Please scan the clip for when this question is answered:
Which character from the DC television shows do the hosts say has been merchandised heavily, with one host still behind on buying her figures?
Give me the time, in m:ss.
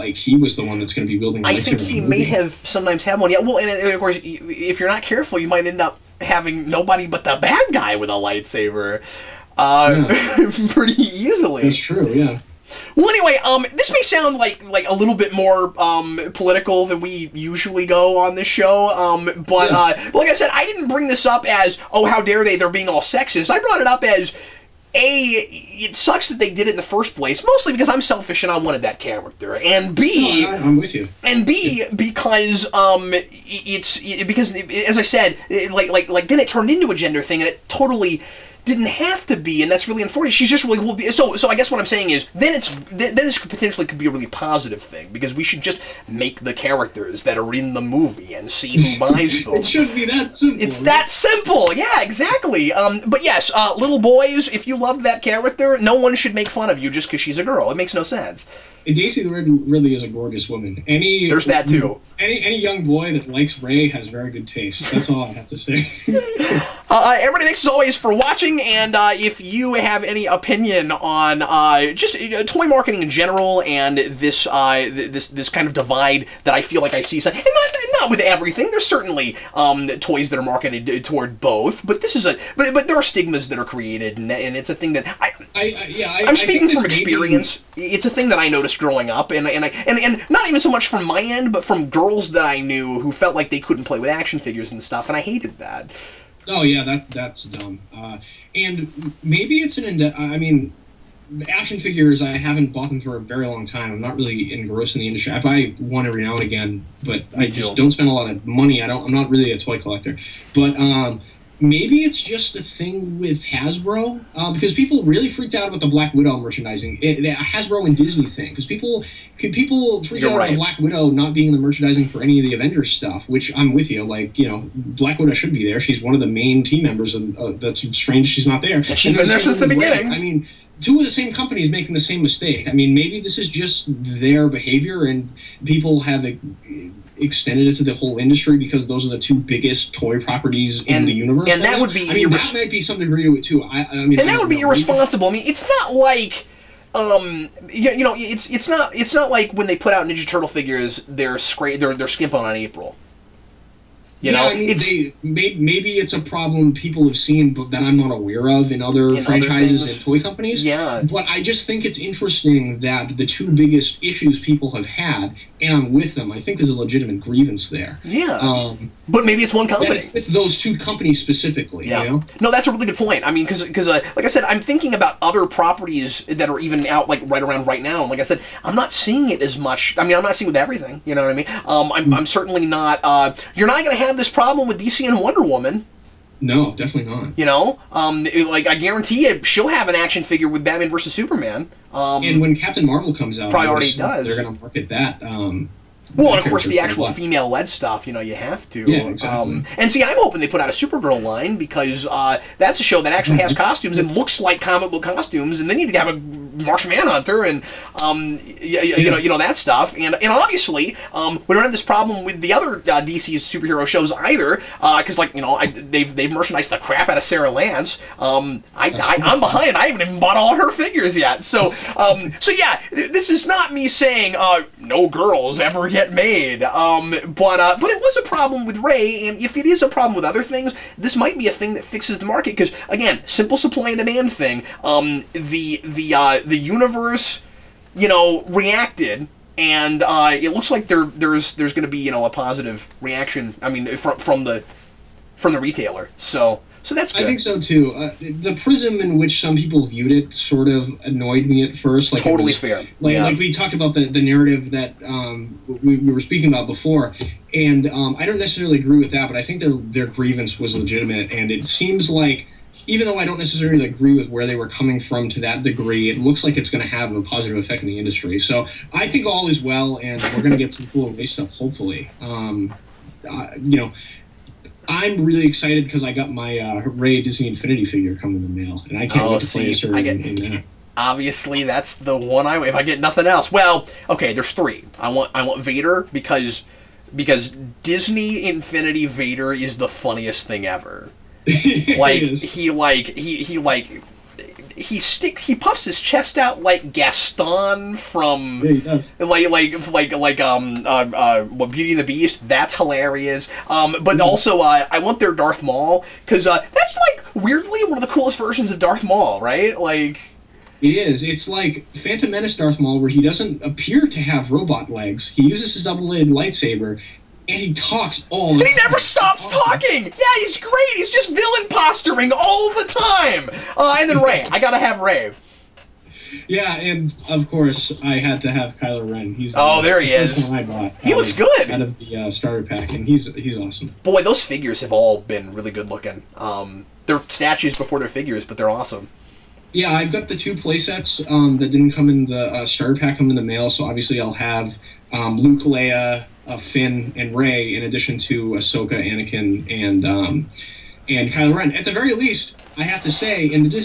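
3:37.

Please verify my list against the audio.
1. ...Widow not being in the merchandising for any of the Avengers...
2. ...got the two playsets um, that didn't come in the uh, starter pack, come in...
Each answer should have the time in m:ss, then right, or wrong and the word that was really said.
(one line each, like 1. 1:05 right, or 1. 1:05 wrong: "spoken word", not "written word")
1. 2:00 right
2. 5:40 right.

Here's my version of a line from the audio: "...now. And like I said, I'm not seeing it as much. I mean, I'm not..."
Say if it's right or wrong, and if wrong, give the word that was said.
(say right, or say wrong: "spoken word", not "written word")
right.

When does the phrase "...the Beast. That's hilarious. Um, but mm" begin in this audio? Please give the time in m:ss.
5:01.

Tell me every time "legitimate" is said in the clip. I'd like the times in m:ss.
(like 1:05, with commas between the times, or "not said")
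2:46, 4:20.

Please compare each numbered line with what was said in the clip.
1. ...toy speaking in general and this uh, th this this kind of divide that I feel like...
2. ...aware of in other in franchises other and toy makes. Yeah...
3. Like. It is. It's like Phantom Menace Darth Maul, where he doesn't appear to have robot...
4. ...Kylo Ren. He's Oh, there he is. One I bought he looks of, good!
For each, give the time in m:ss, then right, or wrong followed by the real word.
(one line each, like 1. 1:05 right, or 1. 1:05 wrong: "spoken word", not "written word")
1. 1:12 wrong: "marketing", not "speaking"
2. 2:38 wrong: "companies", not "makes"
3. 5:09 right
4. 5:28 right.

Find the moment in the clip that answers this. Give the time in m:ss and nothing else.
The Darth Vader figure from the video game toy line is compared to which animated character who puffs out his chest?
4:56.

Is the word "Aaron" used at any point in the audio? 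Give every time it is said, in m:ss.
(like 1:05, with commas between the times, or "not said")
2:45.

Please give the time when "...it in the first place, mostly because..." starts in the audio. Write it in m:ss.
0:26.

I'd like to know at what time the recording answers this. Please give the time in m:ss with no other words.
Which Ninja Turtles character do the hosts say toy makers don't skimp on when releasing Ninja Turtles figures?
2:32.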